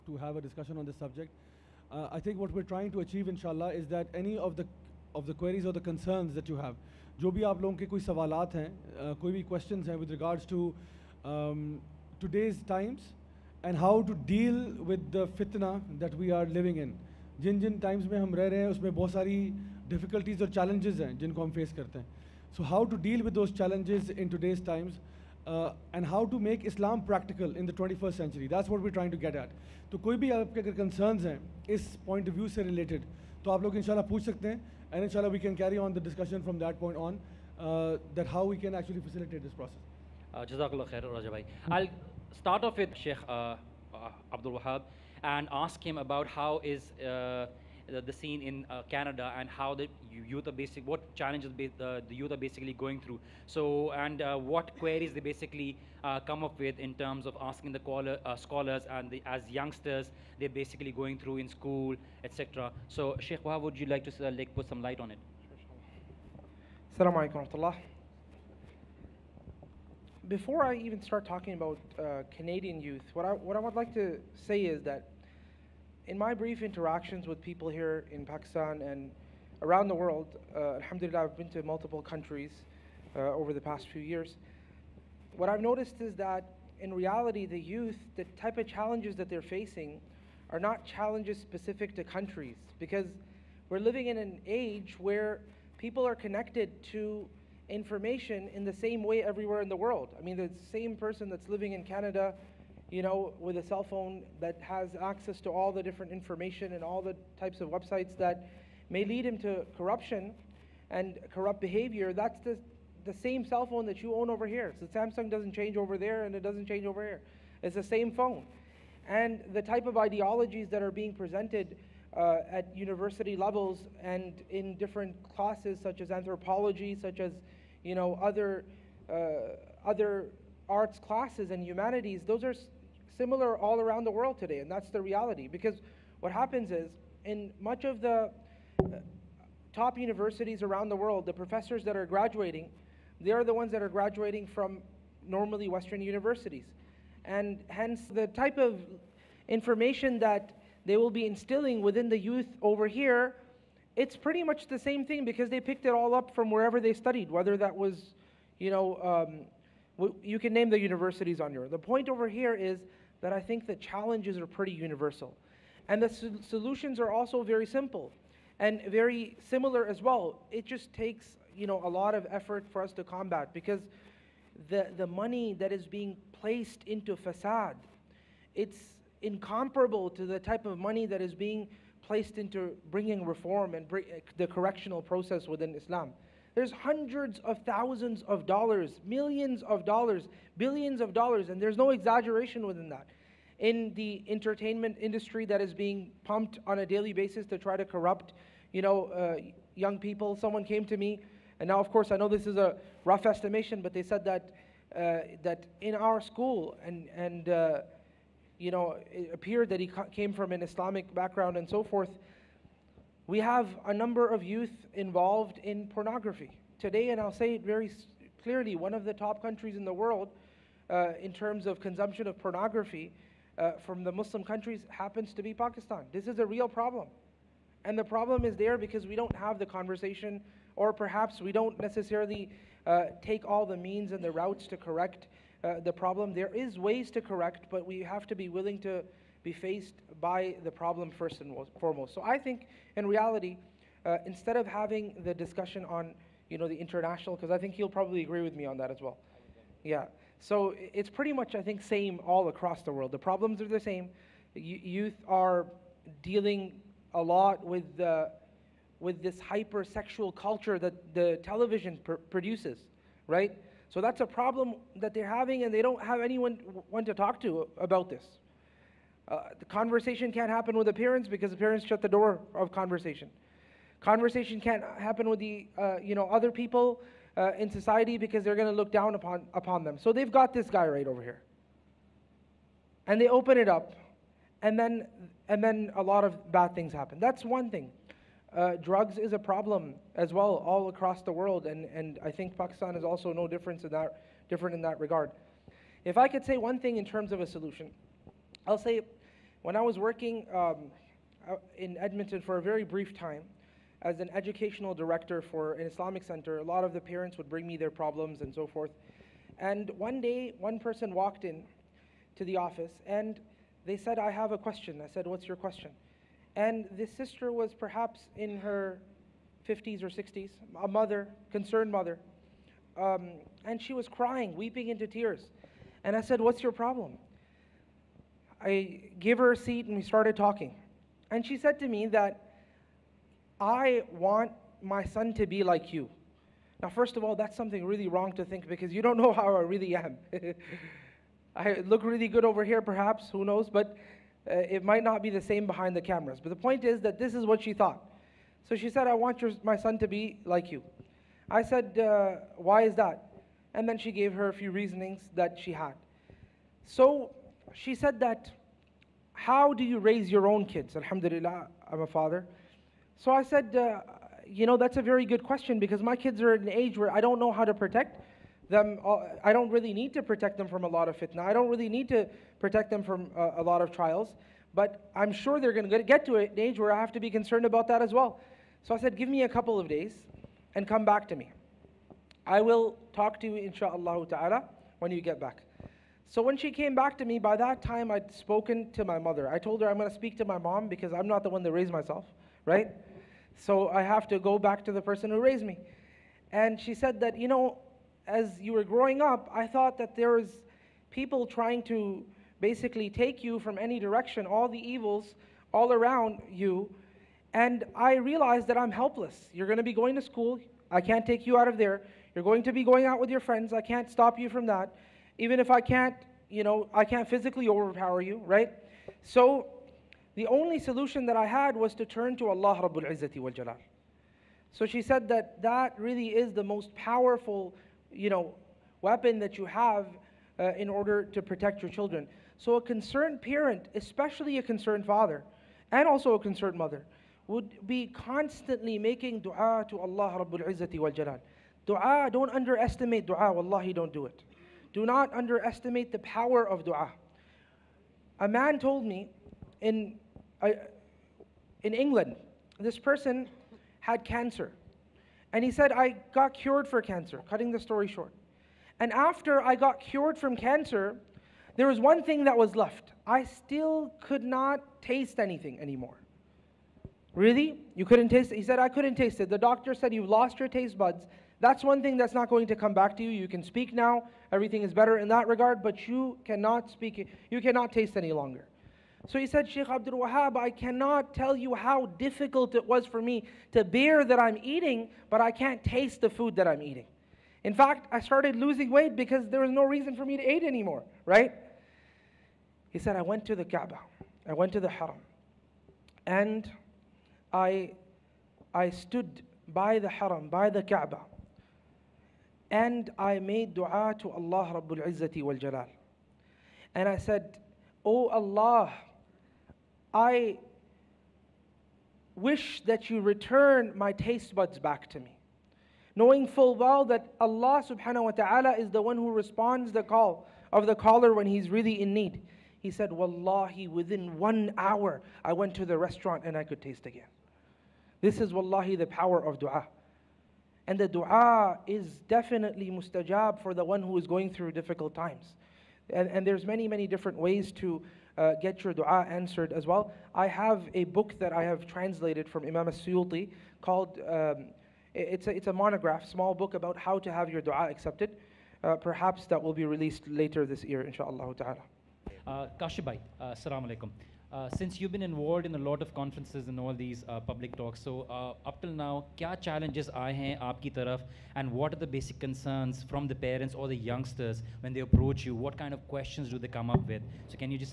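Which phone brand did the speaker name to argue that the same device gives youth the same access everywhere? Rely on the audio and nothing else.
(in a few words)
Samsung.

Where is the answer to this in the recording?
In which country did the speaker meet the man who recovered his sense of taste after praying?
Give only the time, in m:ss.
7:31.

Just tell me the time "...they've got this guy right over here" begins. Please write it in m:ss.
4:40.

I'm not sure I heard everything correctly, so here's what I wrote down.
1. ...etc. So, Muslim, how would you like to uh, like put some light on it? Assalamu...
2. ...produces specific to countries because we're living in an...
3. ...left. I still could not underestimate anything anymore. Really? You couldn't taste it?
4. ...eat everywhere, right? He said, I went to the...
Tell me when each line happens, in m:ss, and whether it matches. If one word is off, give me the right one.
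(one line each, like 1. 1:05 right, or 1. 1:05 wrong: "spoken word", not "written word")
1. 1:02 wrong: "Sheikh", not "Muslim"
2. 1:30 wrong: "challenges", not "produces"
3. 7:42 wrong: "taste", not "underestimate"
4. 8:10 wrong: "anymore", not "everywhere".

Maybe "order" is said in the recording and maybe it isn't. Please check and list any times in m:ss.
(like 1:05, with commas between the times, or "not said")
7:10.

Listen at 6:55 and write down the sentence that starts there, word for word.
Even if I can't, you know, I can't physically overpower you, right?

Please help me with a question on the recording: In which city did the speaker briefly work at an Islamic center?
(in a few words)
Edmonton.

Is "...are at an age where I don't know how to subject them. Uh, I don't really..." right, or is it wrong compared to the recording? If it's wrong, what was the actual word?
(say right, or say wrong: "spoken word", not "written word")
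wrong: "protect", not "subject".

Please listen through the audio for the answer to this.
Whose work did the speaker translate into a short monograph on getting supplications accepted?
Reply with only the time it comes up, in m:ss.
9:02.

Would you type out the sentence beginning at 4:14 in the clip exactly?
Youth are dealing a lot with the, with this hypersexual culture that the television pr- produces, right?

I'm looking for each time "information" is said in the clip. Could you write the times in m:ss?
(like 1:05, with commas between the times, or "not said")
1:37, 1:46, 2:29.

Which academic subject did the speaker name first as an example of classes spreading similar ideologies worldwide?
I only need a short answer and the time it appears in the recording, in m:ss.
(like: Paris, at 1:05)
anthropology, at 2:06.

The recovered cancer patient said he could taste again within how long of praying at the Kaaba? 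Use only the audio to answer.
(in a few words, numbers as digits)
1 hour.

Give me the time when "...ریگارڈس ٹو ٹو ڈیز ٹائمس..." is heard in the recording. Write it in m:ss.
0:10.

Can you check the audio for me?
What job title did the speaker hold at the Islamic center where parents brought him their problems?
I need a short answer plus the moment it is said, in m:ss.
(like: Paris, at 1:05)
educational director, at 5:04.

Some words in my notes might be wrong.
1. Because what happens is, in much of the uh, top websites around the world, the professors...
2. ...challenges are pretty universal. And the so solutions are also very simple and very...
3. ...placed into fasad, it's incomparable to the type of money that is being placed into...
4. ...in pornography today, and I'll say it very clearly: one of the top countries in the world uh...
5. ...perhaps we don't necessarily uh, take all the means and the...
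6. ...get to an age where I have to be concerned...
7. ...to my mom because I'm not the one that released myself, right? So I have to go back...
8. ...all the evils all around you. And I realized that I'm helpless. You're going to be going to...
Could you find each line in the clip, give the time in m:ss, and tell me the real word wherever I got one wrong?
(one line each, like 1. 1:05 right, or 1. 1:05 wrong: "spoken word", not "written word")
1. 2:15 wrong: "universities", not "websites"
2. 2:43 right
3. 2:56 right
4. 3:35 right
5. 3:50 right
6. 6:16 right
7. 6:30 wrong: "raised", not "released"
8. 6:44 right.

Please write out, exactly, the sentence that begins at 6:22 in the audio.
I will talk to you, inshallah ta'ala, when you get back.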